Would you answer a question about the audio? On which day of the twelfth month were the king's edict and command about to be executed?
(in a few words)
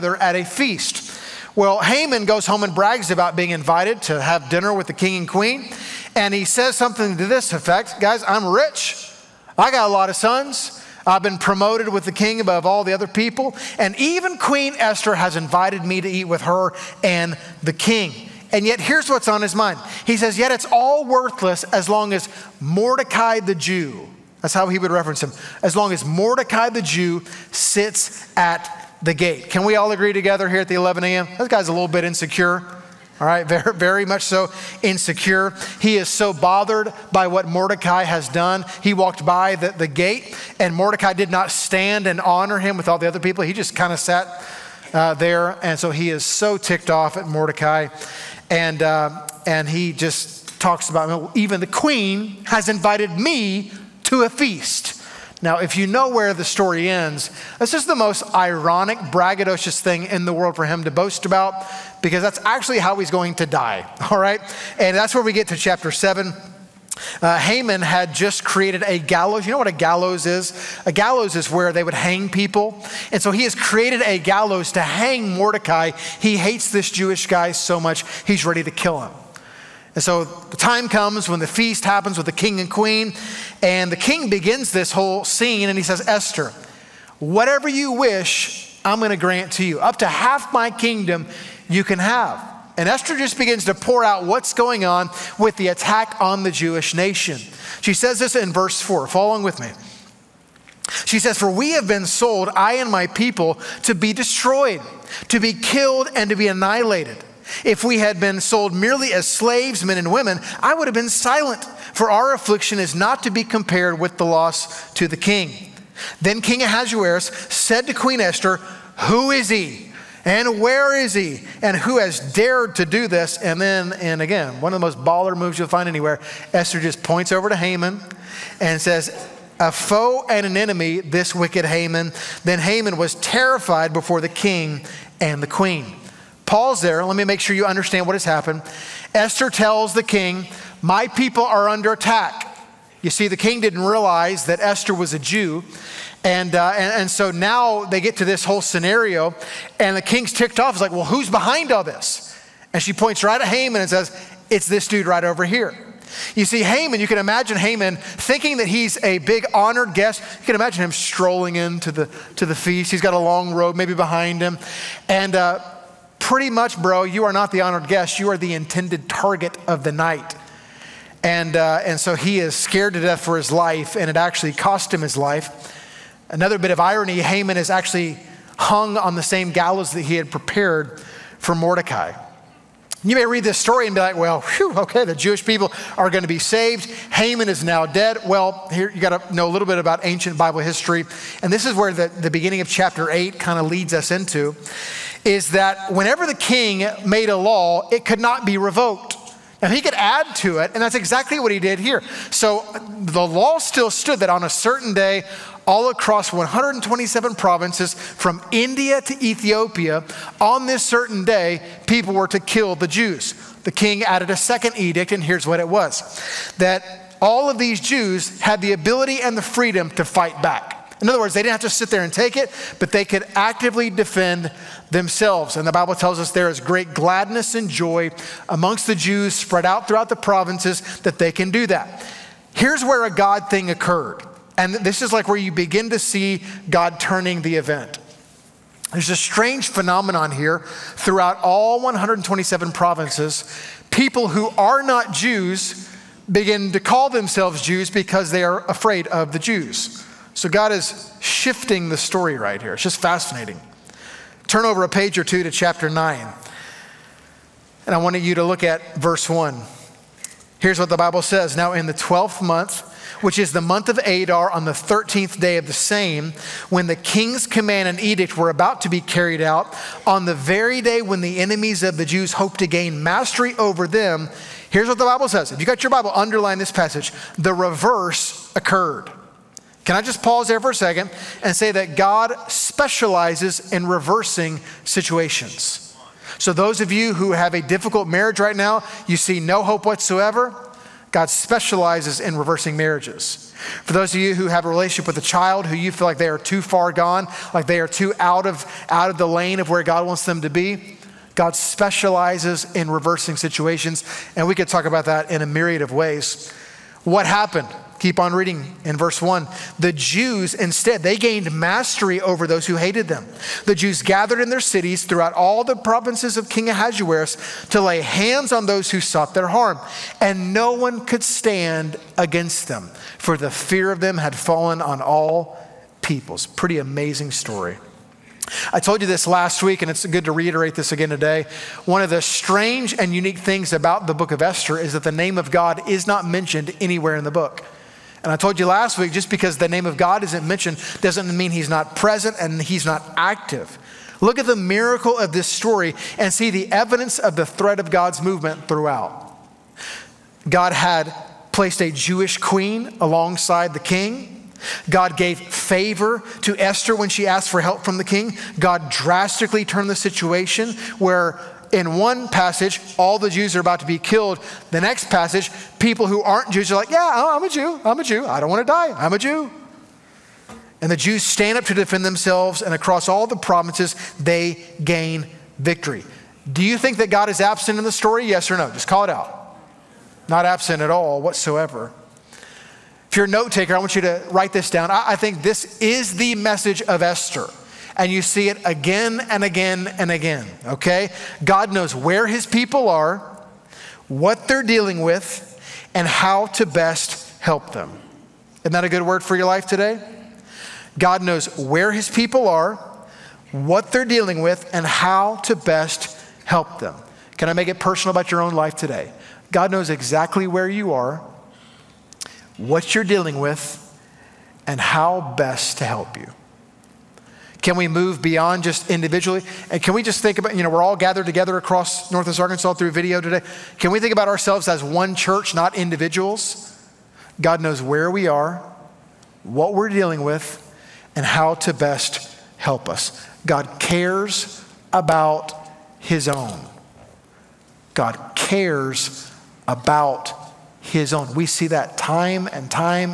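13th.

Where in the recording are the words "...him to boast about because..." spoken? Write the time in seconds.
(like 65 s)
60 s.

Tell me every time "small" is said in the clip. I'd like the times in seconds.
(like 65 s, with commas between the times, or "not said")
not said.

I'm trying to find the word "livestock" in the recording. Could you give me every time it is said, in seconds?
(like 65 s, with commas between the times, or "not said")
not said.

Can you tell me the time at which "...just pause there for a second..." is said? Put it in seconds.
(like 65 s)
280 s.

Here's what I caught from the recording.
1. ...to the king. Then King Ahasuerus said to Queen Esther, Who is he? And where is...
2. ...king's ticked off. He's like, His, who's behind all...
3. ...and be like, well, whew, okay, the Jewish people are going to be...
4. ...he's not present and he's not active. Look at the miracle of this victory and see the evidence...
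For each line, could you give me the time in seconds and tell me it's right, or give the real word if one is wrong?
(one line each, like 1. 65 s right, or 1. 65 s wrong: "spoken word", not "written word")
1. 114 s right
2. 150 s wrong: "Well", not "His"
3. 183 s right
4. 341 s wrong: "story", not "victory".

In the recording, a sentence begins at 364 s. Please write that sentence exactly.
The next passage, people who aren't Jews are like, Yeah, oh, I'm a Jew.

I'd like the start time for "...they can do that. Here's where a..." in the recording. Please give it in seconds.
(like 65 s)
231 s.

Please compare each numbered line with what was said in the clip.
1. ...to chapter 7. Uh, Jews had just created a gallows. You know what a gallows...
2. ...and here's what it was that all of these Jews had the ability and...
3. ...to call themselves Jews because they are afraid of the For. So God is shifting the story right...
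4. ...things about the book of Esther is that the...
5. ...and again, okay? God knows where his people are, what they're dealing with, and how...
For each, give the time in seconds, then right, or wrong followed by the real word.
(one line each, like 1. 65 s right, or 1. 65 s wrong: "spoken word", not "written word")
1. 65 s wrong: "Haman", not "Jews"
2. 215 s right
3. 246 s wrong: "Jews", not "For"
4. 333 s right
5. 389 s right.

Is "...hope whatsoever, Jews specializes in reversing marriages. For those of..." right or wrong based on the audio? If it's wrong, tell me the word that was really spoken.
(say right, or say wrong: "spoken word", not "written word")
wrong: "God", not "Jews".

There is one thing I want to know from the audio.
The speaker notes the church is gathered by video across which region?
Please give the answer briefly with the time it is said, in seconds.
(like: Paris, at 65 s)
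Northwest Arkansas, at 422 s.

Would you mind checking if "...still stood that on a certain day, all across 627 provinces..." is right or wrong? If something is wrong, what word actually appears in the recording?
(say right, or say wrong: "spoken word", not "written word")
wrong: "127", not "627".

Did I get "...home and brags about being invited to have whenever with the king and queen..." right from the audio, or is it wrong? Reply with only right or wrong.
wrong.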